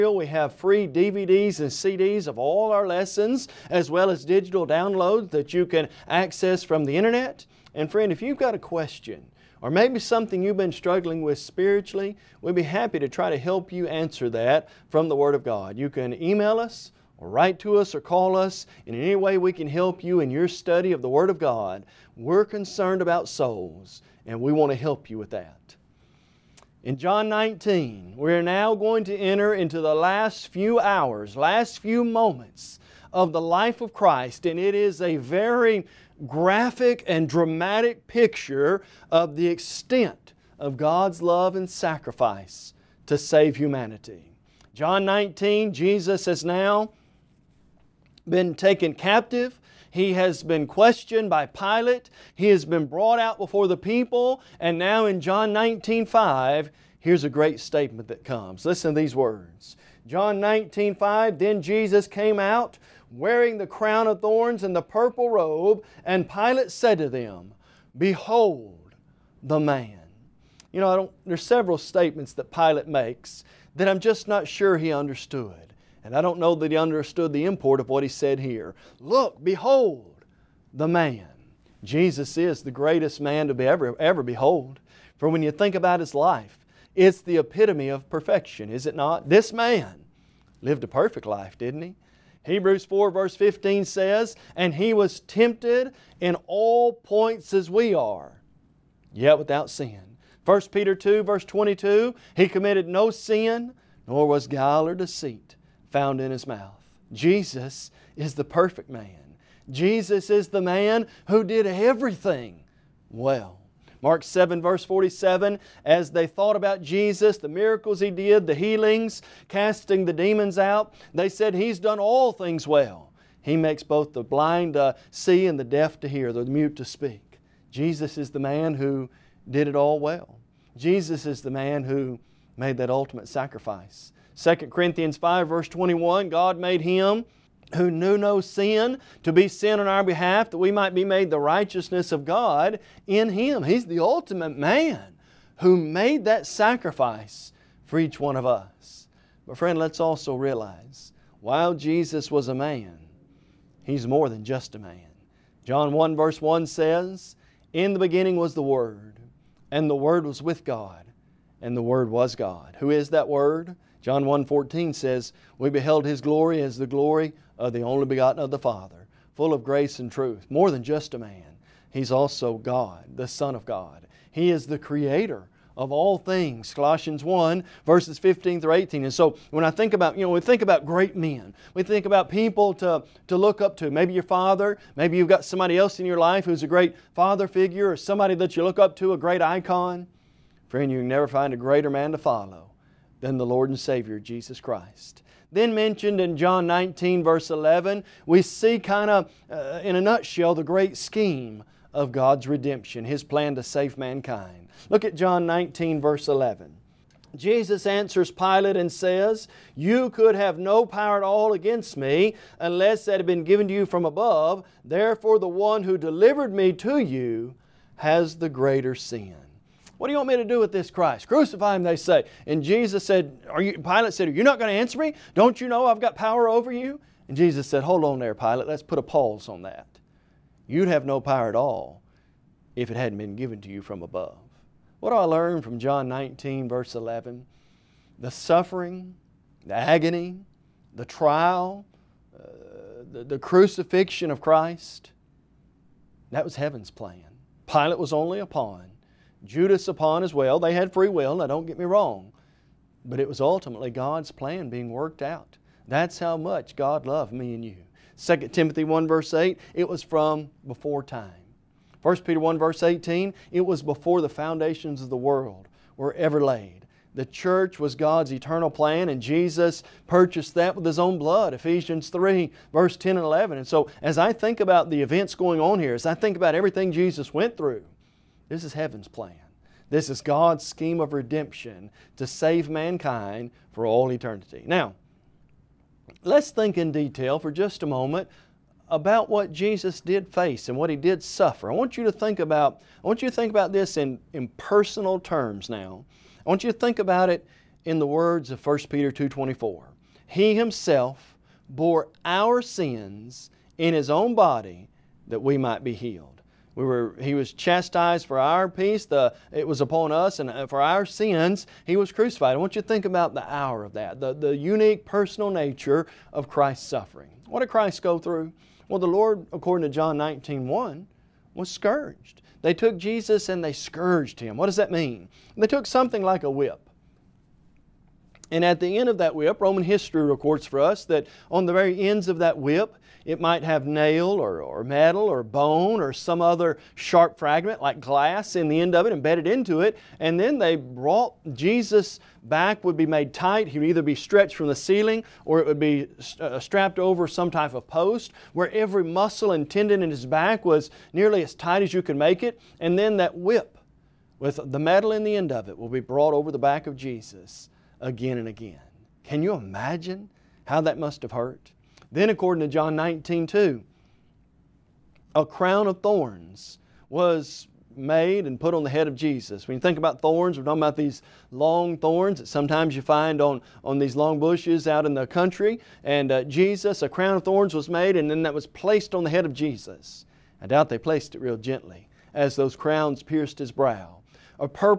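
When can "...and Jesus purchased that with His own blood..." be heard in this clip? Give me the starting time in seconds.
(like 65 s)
269 s.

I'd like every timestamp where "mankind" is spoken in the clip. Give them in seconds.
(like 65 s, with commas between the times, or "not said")
203 s, 282 s.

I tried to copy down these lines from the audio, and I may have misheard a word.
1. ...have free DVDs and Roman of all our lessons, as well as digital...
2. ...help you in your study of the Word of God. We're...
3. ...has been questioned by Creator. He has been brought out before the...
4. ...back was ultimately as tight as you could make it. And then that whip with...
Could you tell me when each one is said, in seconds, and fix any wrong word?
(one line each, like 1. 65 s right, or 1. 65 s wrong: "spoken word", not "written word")
1. 0 s wrong: "CDs", not "Roman"
2. 19 s right
3. 50 s wrong: "Pilate", not "Creator"
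4. 350 s wrong: "nearly", not "ultimately".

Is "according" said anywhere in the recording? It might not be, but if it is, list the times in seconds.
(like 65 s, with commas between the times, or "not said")
319 s, 362 s.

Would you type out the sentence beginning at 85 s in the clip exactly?
For when you think about his life, it's the epitome of perfection, is it not?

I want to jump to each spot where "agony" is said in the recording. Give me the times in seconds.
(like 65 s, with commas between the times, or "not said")
239 s.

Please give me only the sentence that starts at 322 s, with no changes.
They took Jesus and they scourged him.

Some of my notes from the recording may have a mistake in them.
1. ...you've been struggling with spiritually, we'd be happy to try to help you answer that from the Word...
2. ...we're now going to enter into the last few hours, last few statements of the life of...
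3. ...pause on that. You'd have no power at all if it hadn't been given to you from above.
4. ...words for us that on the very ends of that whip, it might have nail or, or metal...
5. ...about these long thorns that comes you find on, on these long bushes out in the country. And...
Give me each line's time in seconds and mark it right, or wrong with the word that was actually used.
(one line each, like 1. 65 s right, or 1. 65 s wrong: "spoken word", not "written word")
1. 10 s right
2. 28 s wrong: "moments", not "statements"
3. 229 s right
4. 330 s wrong: "records", not "words"
5. 370 s wrong: "sometimes", not "comes".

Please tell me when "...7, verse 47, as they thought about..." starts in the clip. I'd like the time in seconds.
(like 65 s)
114 s.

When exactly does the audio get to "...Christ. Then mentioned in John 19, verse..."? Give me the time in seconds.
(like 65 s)
194 s.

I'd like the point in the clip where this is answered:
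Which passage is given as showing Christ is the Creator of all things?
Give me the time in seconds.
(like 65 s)
176 s.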